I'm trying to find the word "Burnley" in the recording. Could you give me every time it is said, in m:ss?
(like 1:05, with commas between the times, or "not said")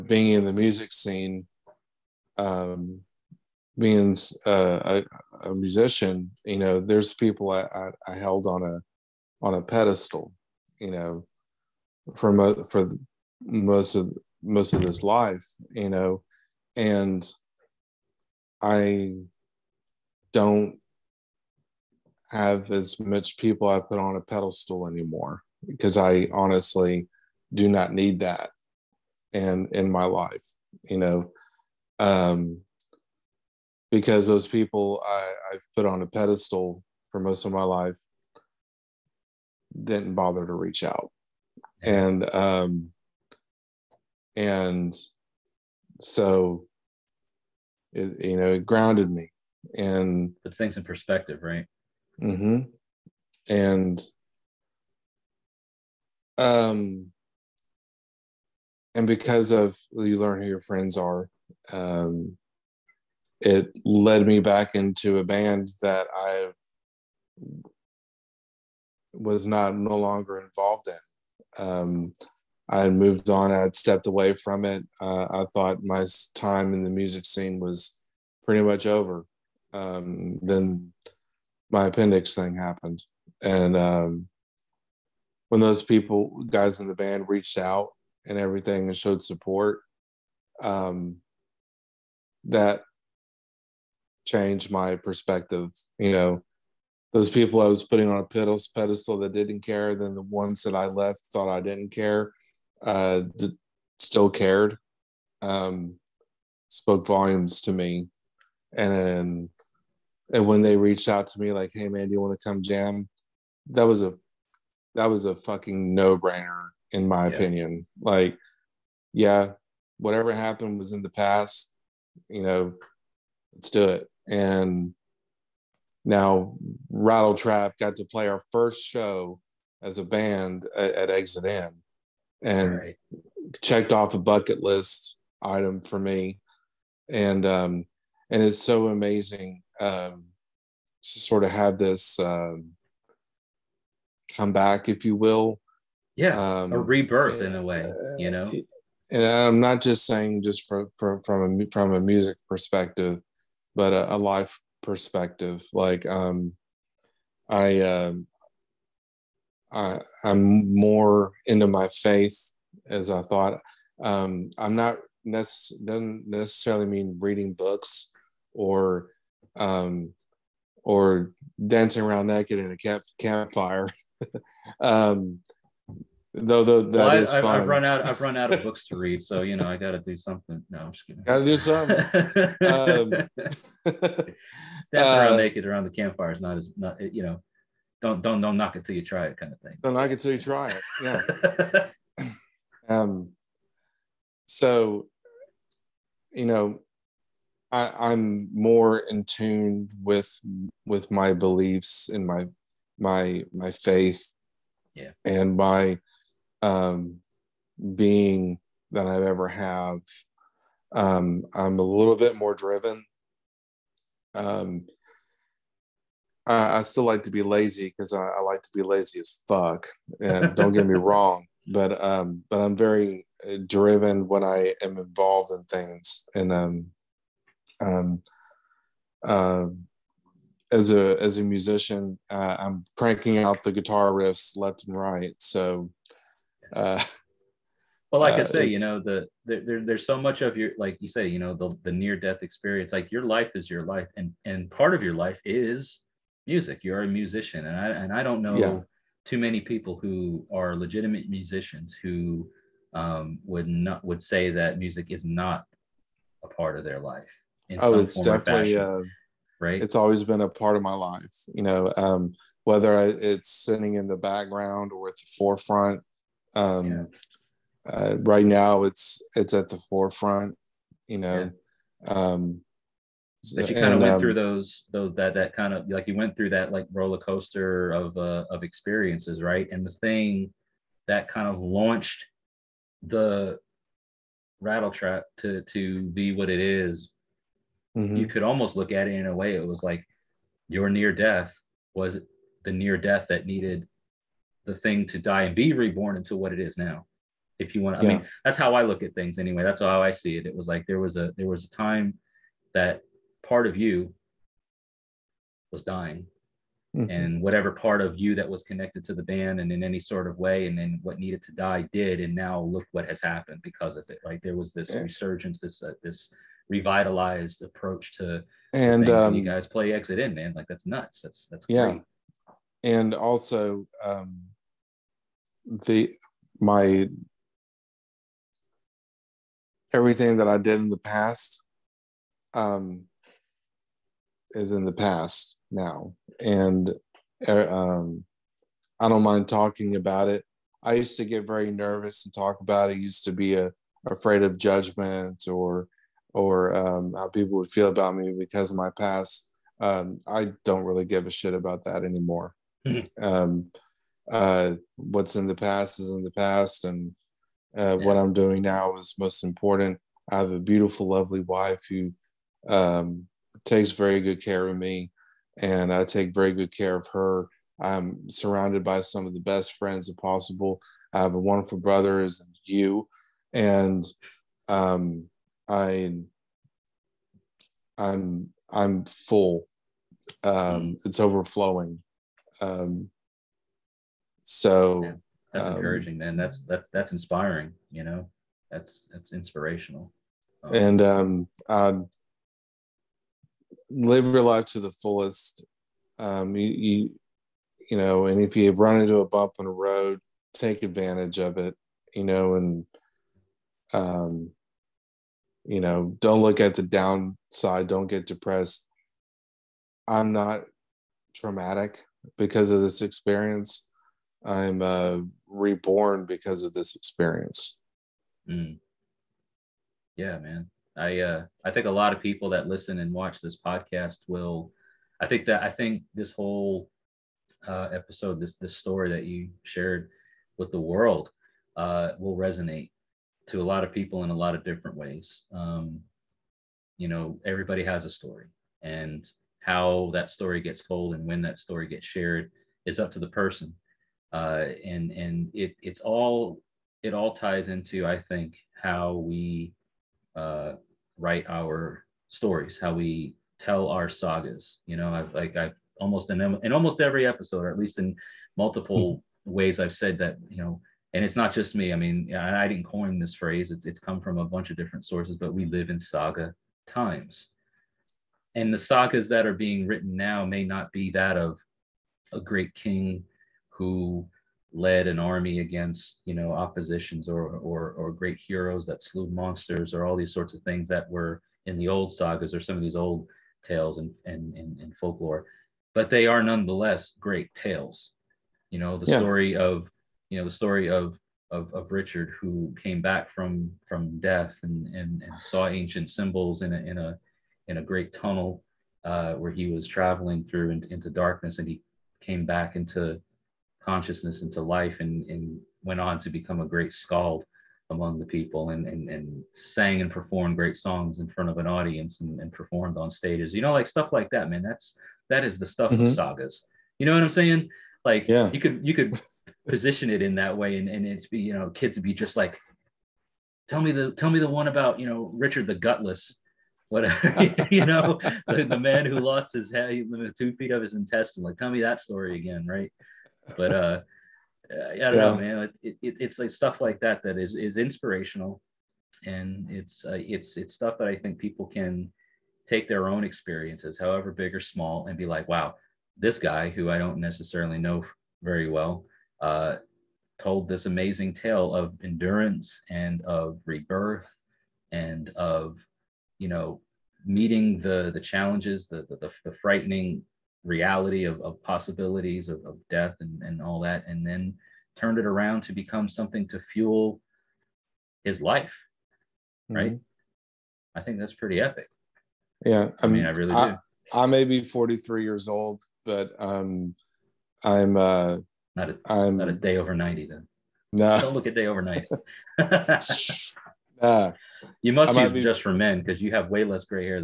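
not said.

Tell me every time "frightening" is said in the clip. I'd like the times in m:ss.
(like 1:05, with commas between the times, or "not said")
9:19.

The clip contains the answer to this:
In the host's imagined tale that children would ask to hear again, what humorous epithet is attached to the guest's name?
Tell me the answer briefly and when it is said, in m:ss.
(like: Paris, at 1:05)
the gutless, at 8:45.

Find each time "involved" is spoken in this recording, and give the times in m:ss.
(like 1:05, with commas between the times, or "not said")
1:10, 3:44.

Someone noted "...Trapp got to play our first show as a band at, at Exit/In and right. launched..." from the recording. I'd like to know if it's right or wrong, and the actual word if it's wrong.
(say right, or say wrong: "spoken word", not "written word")
wrong: "checked", not "launched".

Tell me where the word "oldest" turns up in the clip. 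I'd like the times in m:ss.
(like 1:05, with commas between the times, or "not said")
not said.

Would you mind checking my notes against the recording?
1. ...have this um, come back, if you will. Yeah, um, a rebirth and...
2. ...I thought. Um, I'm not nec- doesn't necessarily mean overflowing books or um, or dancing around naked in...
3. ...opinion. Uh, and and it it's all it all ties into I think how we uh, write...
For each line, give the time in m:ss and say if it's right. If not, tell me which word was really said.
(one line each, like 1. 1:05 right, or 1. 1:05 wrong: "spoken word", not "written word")
1. 2:21 right
2. 2:43 wrong: "reading", not "overflowing"
3. 7:23 wrong: "person", not "opinion".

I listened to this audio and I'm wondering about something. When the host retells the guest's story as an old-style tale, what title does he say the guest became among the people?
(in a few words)
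great skald.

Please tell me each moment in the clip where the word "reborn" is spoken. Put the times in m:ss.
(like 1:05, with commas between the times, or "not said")
4:55, 6:55.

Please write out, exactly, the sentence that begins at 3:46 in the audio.
And um, um, uh, as a as a musician, uh, I'm cranking out the guitar riffs left and right.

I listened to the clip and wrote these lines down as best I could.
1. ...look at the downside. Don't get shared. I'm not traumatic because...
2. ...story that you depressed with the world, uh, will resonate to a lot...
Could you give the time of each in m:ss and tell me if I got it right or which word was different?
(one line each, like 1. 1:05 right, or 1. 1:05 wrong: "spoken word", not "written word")
1. 6:46 wrong: "depressed", not "shared"
2. 7:08 wrong: "shared", not "depressed".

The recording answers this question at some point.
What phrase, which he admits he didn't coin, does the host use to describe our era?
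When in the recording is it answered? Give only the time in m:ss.
7:45.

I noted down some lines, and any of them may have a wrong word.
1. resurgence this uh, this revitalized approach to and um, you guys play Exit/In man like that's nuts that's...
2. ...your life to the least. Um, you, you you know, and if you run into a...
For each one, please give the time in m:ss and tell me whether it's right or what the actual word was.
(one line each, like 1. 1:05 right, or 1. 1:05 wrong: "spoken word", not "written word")
1. 5:14 right
2. 6:34 wrong: "fullest", not "least".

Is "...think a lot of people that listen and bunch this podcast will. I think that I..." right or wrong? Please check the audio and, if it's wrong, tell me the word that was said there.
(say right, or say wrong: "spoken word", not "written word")
wrong: "watch", not "bunch".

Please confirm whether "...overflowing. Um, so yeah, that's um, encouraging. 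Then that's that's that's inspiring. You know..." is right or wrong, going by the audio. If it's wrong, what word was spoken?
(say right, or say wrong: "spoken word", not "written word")
right.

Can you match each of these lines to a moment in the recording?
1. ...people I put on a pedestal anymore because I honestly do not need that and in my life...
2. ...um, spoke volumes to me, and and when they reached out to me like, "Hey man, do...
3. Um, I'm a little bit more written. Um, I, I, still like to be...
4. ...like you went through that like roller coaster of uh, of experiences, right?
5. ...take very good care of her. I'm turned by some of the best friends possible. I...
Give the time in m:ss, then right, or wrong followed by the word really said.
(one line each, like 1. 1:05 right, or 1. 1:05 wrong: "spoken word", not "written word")
1. 0:23 right
2. 1:45 right
3. 3:30 wrong: "driven", not "written"
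4. 4:35 right
5. 6:06 wrong: "surrounded", not "turned".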